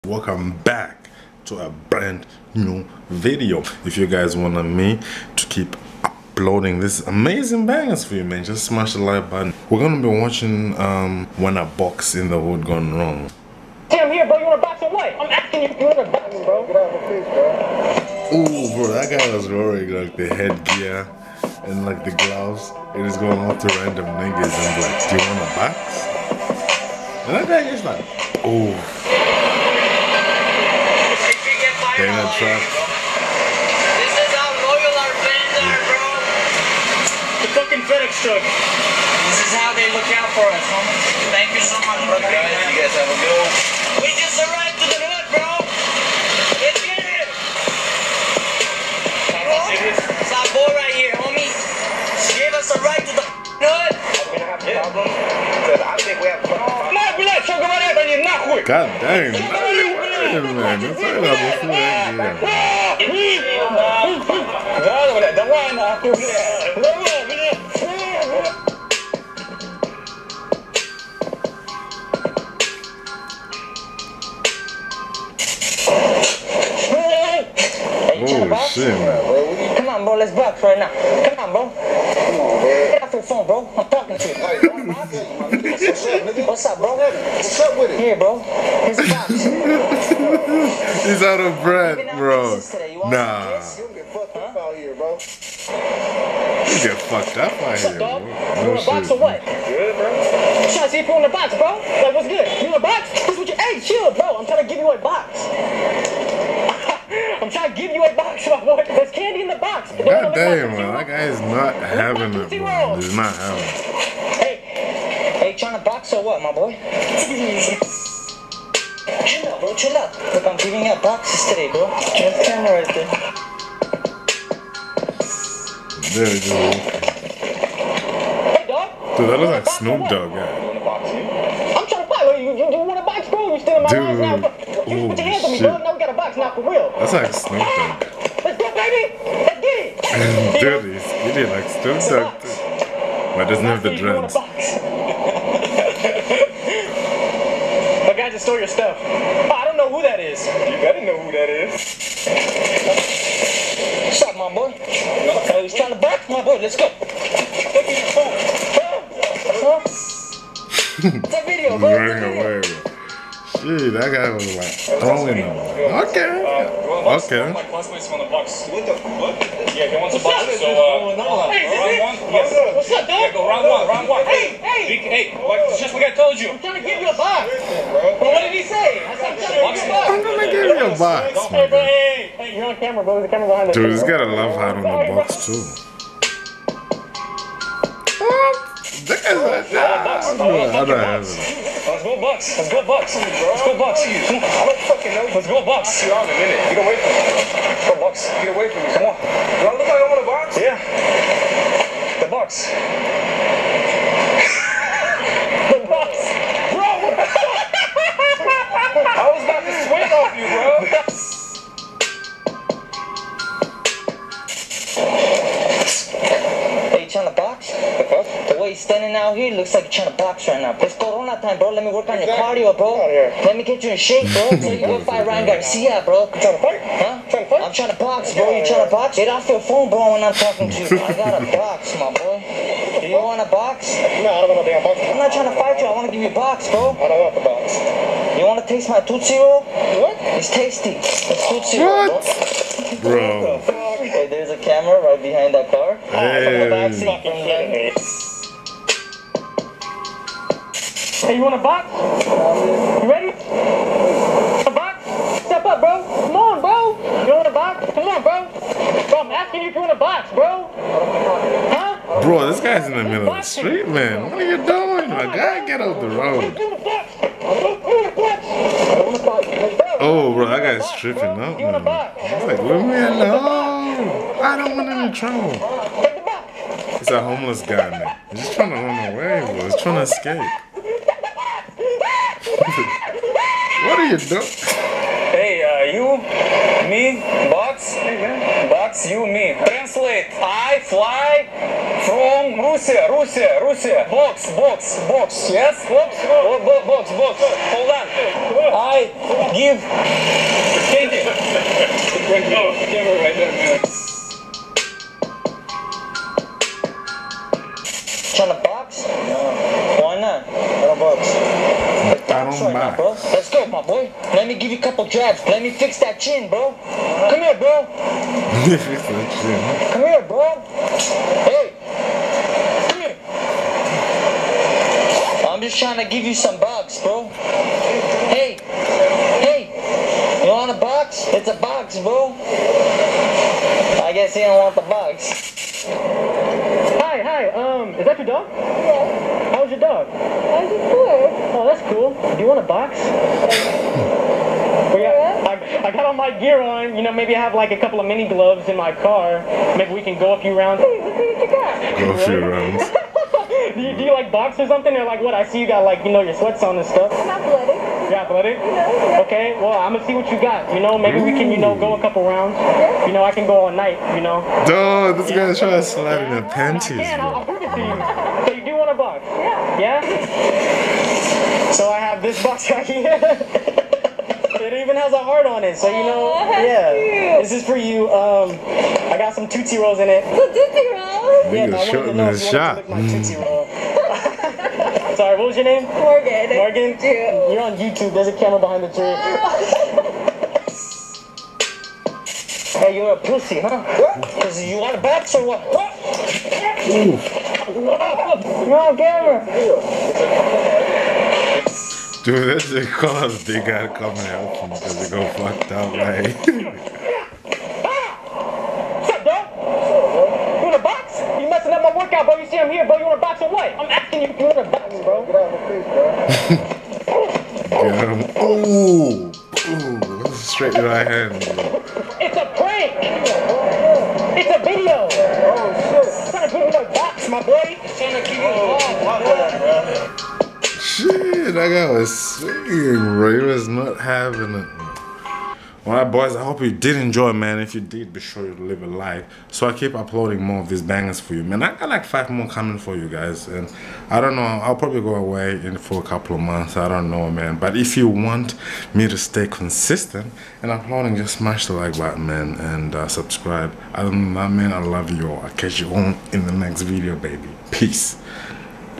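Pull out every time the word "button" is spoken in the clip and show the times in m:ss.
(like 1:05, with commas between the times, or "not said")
0:09, 6:54, 7:31.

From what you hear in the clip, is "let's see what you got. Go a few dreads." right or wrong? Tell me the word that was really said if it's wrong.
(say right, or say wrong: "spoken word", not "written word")
wrong: "rounds", not "dreads".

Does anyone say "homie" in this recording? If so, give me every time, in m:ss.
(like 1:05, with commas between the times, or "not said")
0:40, 0:51.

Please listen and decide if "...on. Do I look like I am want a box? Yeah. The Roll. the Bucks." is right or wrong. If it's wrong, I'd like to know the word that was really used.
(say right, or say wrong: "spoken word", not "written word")
wrong: "Bucks", not "Roll".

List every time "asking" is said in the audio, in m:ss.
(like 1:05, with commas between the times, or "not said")
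0:15, 4:19.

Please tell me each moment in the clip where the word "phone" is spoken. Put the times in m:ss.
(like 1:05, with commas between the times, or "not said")
1:23, 2:38, 3:49.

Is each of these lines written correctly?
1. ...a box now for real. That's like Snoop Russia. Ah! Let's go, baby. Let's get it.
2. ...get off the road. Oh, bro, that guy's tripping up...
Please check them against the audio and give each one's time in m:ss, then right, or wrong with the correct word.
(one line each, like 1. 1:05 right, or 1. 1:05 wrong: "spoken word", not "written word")
1. 2:16 wrong: "Dogg", not "Russia"
2. 4:25 right.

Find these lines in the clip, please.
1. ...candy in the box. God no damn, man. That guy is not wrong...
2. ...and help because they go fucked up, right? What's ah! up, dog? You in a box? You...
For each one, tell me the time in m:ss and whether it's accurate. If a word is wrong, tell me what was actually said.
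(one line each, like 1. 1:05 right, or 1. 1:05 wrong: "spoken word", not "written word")
1. 1:49 wrong: "having", not "wrong"
2. 6:44 right.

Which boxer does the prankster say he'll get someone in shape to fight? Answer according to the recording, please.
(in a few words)
Ryan Garcia.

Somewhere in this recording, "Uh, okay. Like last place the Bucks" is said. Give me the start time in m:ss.
2:46.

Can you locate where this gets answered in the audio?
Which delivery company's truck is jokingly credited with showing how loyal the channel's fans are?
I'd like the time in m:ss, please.
0:37.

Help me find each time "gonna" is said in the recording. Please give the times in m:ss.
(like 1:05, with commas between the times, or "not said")
0:09, 3:00, 5:59.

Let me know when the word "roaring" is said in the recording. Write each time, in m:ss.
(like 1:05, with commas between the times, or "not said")
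0:19.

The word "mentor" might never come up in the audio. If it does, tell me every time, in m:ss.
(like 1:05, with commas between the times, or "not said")
not said.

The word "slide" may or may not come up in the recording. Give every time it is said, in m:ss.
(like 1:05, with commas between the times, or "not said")
6:05.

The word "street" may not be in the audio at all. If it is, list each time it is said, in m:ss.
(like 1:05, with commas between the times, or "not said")
4:23.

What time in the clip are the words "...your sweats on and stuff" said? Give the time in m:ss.
5:56.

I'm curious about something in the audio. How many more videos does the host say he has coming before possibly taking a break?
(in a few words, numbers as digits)
5.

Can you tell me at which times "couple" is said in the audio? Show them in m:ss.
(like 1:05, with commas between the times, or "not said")
5:14, 5:47, 6:02, 7:26.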